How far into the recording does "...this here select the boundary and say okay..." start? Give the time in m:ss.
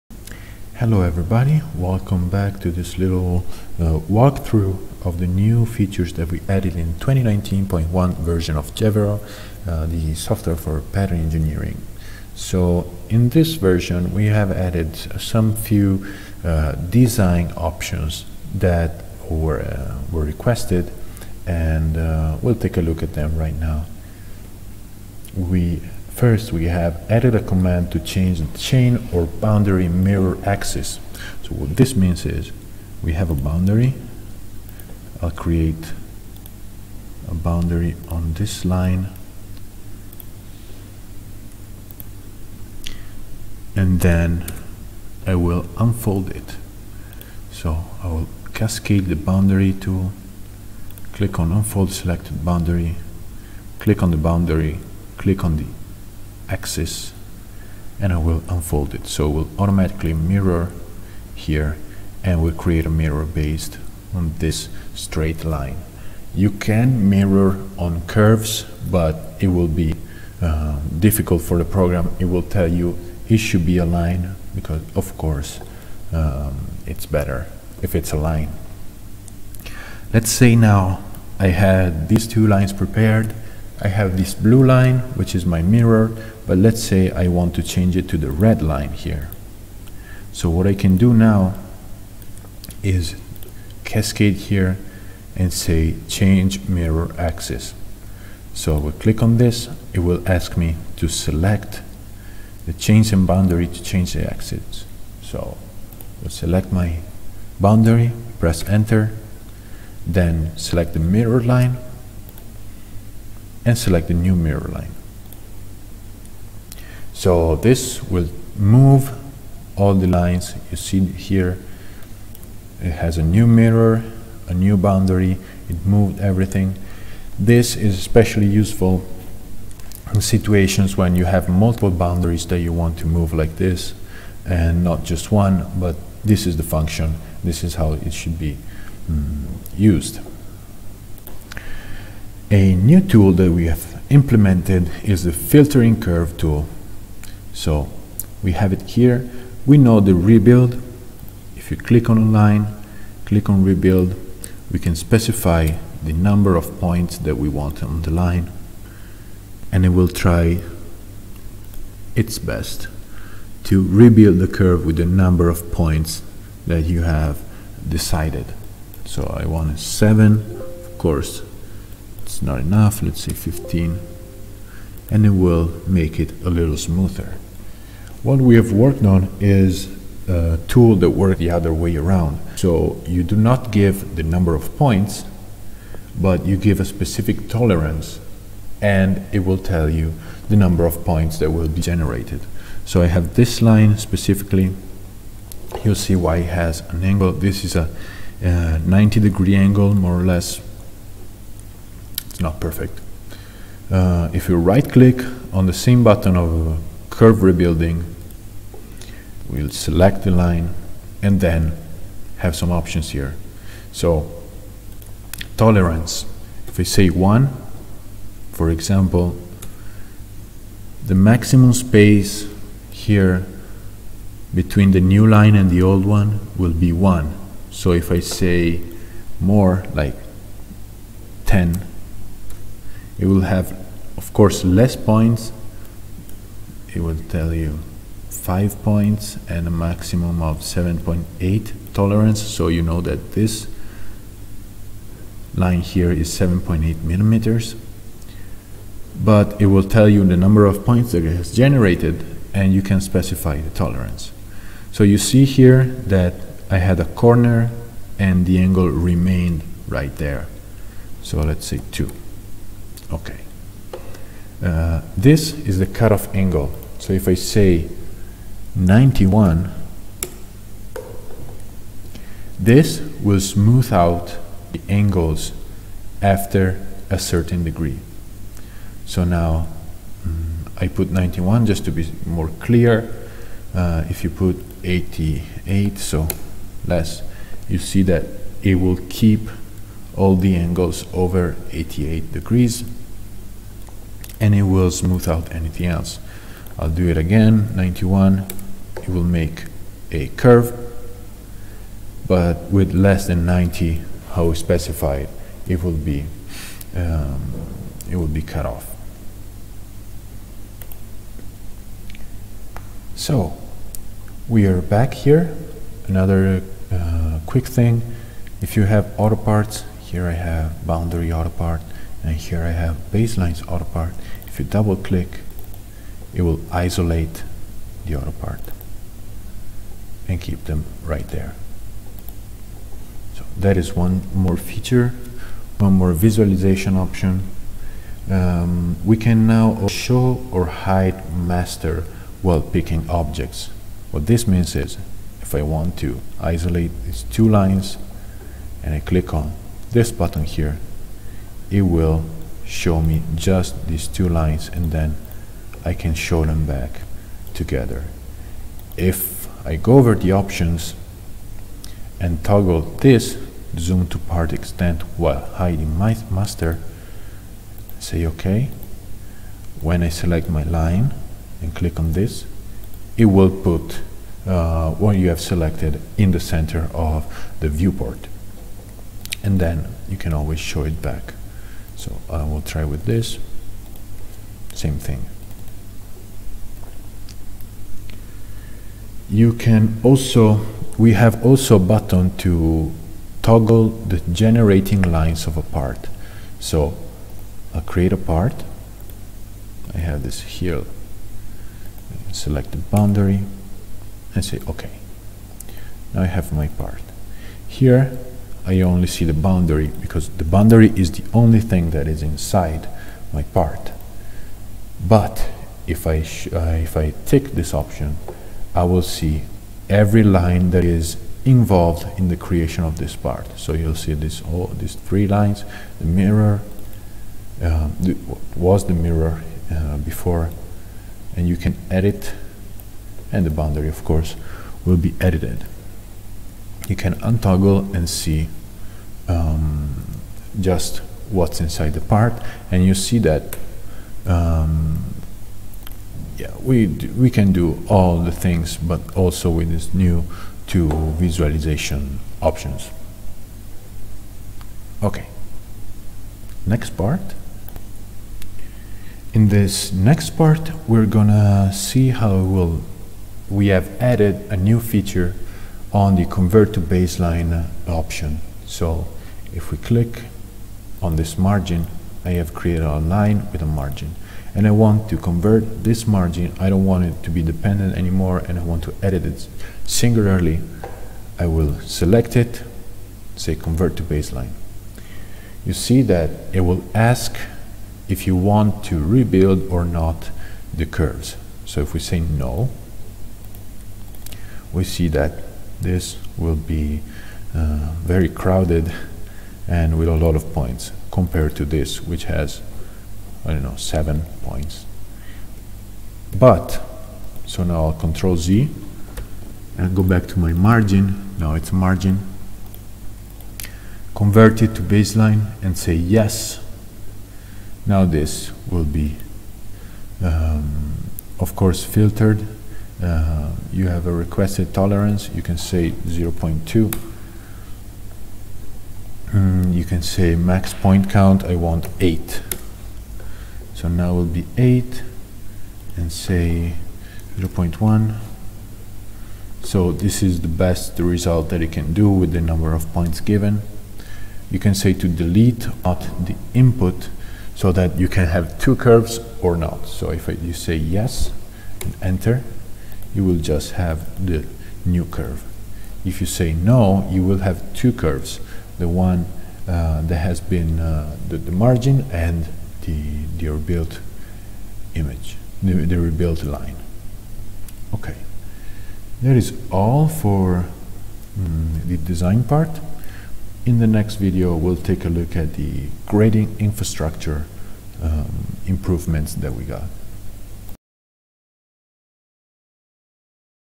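6:40.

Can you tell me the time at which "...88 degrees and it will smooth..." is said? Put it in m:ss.
4:51.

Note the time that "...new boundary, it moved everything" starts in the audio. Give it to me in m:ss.
2:04.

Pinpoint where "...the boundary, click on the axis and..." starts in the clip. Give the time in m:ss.
0:54.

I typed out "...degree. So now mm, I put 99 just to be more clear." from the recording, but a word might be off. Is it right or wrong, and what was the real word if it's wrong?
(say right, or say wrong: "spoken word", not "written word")
wrong: "91", not "99".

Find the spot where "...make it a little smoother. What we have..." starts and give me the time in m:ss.
2:55.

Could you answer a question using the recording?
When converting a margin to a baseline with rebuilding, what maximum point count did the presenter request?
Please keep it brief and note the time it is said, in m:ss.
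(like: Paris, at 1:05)
8, at 8:51.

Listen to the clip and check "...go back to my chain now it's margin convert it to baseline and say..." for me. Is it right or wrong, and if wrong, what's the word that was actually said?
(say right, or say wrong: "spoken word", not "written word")
wrong: "margin", not "chain".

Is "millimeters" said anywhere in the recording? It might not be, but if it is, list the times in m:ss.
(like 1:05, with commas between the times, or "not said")
4:07.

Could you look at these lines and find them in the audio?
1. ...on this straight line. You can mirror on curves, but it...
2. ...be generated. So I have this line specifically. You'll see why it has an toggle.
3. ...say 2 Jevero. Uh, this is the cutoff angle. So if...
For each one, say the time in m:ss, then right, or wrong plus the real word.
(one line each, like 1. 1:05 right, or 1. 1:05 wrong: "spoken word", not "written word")
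1. 1:04 right
2. 3:11 wrong: "angle", not "toggle"
3. 4:21 wrong: "Okay", not "Jevero".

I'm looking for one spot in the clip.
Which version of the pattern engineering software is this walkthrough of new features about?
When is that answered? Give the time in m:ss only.
0:06.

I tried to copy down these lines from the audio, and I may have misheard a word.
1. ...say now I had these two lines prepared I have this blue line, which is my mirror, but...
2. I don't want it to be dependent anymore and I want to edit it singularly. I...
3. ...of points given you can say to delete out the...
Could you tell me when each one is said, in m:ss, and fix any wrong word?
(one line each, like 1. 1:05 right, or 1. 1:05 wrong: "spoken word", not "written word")
1. 1:20 right
2. 7:56 right
3. 9:02 right.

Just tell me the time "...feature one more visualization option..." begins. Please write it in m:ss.
5:34.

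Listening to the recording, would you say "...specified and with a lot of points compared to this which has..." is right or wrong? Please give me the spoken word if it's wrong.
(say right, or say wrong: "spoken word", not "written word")
wrong: "crowded", not "specified".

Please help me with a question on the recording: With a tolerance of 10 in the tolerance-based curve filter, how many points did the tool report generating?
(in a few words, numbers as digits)
5.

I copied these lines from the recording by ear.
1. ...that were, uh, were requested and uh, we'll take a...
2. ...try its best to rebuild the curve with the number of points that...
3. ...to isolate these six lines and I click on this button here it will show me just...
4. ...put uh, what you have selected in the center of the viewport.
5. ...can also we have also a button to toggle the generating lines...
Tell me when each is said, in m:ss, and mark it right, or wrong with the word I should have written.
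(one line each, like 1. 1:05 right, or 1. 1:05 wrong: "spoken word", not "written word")
1. 0:18 right
2. 2:40 right
3. 5:45 wrong: "two", not "six"
4. 6:13 right
5. 6:29 right.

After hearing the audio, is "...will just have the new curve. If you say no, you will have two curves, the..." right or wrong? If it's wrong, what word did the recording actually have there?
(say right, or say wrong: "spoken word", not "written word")
right.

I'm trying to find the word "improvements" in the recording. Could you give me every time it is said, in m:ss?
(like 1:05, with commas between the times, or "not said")
9:38.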